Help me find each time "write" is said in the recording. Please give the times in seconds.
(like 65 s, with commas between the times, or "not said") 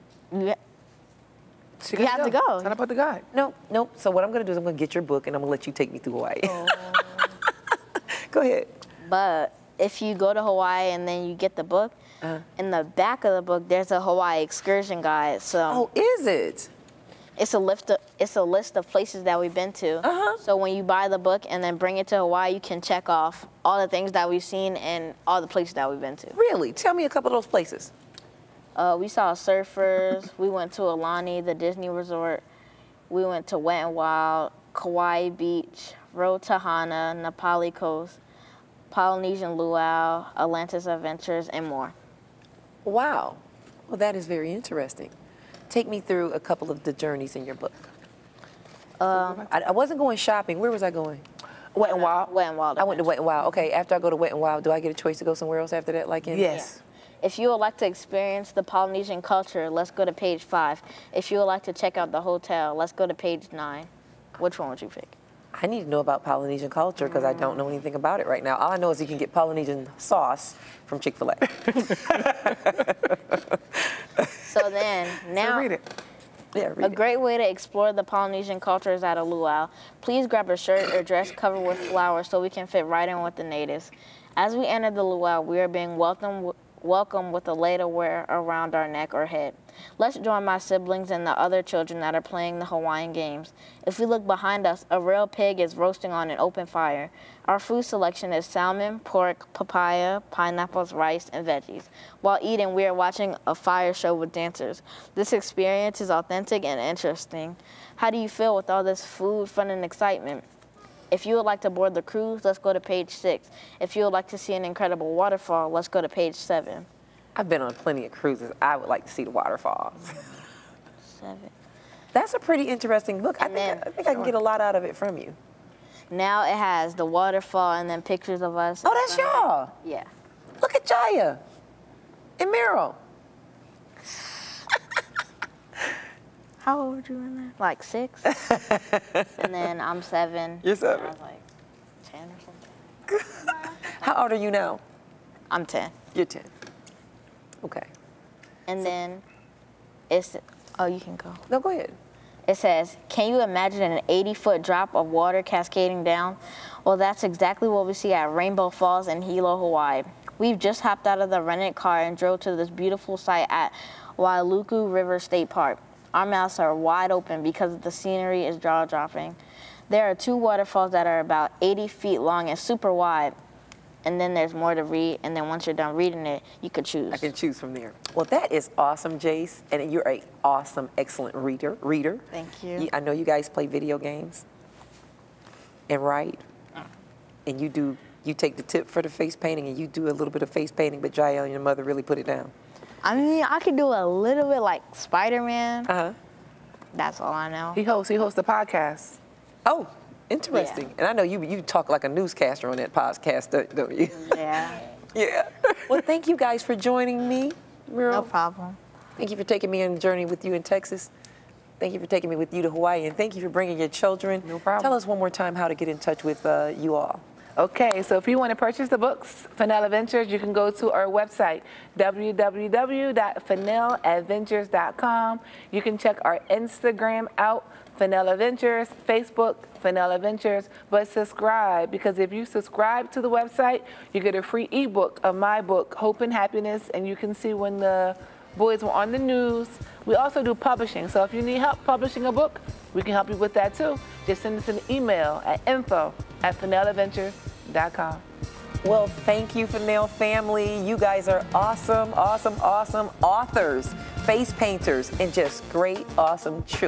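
186 s.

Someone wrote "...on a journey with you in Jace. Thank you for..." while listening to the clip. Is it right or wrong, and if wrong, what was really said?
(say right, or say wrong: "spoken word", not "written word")
wrong: "Texas", not "Jace".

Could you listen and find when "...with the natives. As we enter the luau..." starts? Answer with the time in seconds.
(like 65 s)
83 s.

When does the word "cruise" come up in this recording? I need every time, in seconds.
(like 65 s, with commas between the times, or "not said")
112 s, 118 s.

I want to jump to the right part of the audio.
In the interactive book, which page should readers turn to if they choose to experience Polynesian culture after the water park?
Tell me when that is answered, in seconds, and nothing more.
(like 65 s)
60 s.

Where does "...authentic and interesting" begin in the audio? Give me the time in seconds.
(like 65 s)
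106 s.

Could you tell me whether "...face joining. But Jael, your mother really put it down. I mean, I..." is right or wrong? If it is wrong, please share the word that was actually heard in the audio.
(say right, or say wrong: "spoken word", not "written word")
wrong: "painting", not "joining".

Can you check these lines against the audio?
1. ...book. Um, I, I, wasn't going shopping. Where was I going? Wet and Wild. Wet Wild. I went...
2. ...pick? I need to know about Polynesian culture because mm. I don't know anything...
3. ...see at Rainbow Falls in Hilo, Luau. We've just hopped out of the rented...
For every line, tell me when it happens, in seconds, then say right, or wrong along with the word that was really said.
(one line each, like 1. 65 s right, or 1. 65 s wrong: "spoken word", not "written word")
1. 47 s right
2. 64 s right
3. 157 s wrong: "Hawaii", not "Luau".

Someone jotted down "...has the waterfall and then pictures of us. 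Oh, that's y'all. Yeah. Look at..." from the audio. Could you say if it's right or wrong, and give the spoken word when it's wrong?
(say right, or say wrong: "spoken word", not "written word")
right.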